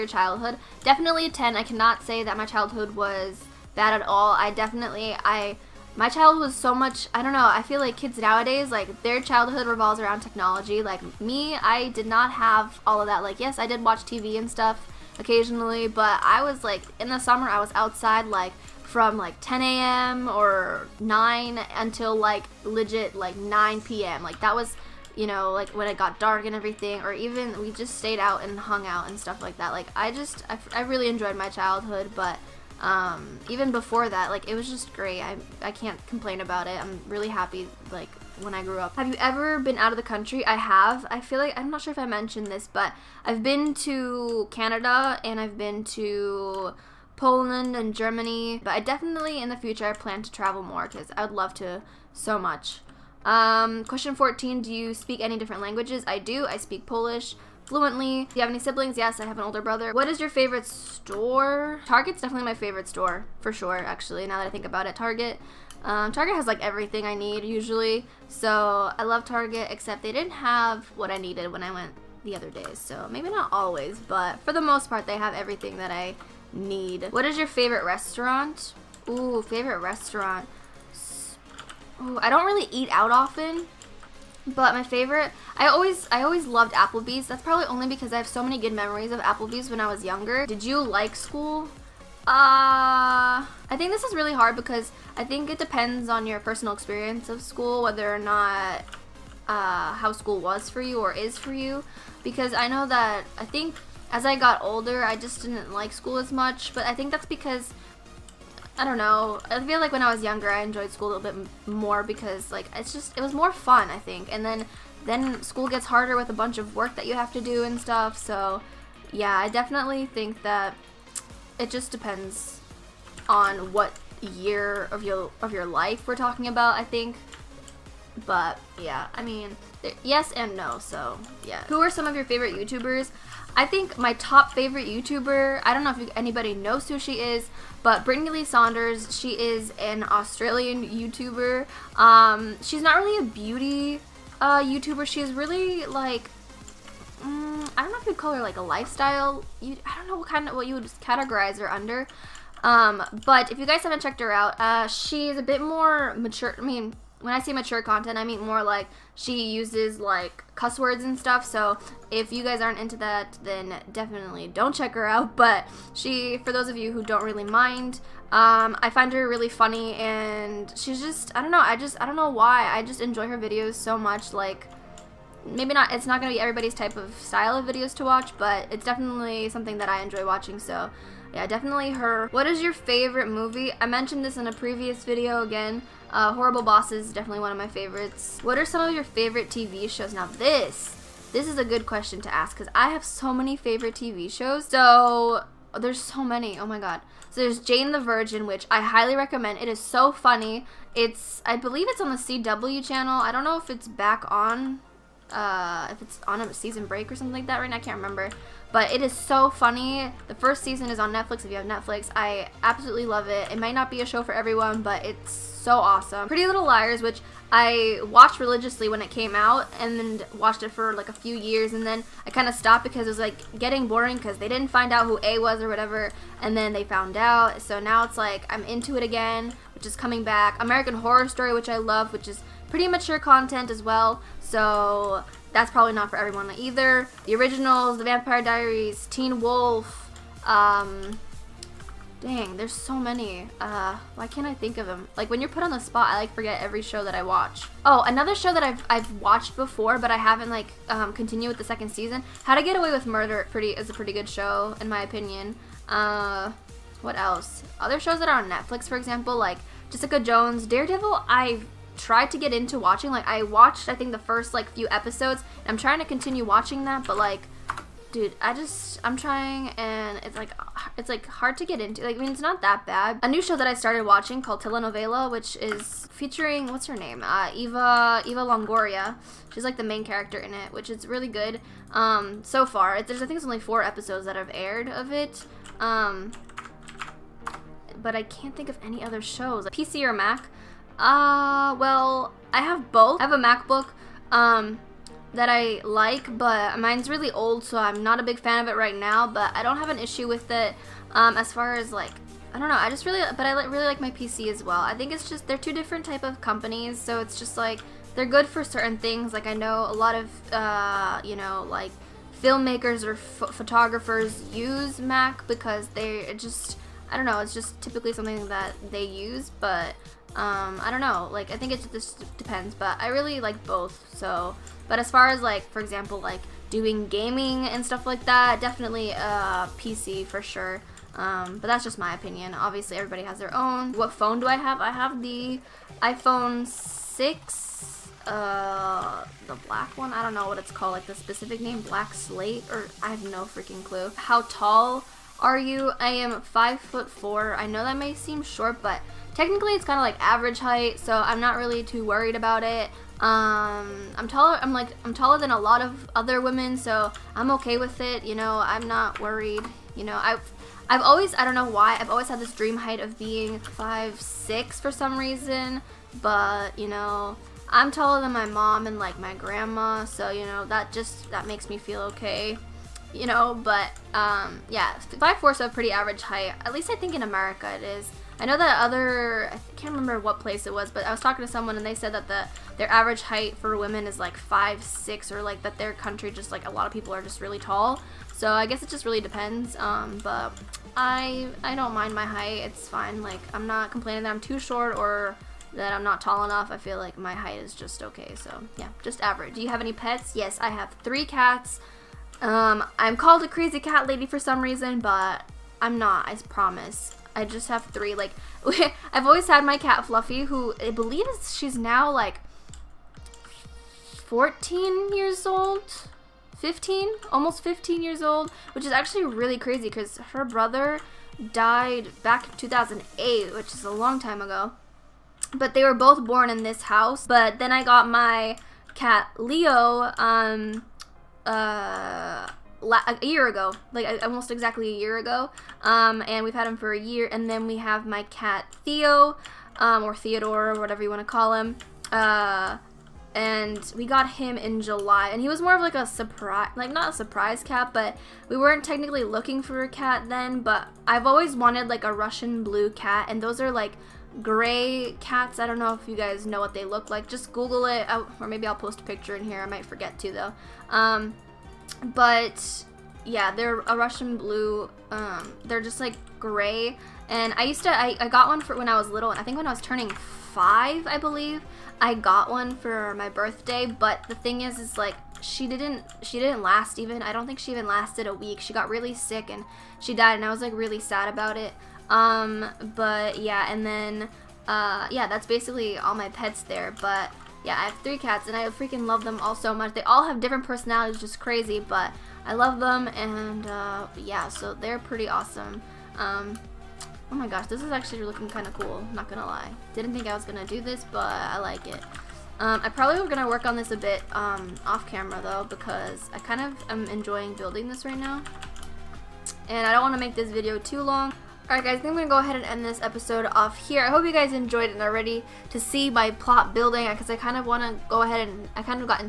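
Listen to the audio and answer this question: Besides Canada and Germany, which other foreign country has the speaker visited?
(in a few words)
Poland.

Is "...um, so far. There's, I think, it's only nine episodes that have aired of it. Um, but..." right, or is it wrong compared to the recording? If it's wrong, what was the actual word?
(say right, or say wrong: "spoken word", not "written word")
wrong: "four", not "nine".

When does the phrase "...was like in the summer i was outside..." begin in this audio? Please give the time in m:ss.
0:16.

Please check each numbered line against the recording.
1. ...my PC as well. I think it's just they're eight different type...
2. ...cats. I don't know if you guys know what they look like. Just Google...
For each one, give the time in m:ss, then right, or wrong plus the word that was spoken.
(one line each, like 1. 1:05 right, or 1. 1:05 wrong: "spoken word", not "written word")
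1. 5:03 wrong: "two", not "eight"
2. 7:35 right.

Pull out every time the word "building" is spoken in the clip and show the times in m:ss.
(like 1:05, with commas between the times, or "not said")
8:27, 8:36.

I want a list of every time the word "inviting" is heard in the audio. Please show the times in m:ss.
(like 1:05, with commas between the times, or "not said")
not said.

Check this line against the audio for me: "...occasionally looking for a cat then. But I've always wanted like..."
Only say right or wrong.
wrong.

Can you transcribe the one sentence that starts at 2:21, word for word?
Um, she's not really a beauty uh, YouTuber.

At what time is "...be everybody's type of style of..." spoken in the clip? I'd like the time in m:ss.
2:56.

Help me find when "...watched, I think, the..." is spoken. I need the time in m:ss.
4:23.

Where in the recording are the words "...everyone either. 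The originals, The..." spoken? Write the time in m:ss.
3:56.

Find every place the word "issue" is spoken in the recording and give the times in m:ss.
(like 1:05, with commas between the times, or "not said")
4:59.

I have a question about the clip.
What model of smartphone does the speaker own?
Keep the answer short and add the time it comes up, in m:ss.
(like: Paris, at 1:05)
iPhone 6, at 5:36.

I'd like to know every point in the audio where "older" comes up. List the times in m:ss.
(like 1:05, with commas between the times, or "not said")
0:59, 1:44.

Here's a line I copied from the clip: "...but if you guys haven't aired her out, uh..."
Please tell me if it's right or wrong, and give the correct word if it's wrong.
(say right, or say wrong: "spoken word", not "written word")
wrong: "checked", not "aired".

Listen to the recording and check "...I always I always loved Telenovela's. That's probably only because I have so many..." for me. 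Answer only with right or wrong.
wrong.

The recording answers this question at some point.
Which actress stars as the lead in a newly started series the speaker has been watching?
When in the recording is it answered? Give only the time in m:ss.
4:38.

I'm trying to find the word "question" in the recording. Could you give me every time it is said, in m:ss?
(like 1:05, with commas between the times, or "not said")
0:53, 3:11.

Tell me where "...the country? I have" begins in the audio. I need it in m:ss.
0:39.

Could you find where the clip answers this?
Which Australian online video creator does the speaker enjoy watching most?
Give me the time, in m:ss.
2:18.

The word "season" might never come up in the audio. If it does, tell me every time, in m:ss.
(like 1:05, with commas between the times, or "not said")
3:26, 3:30, 4:11.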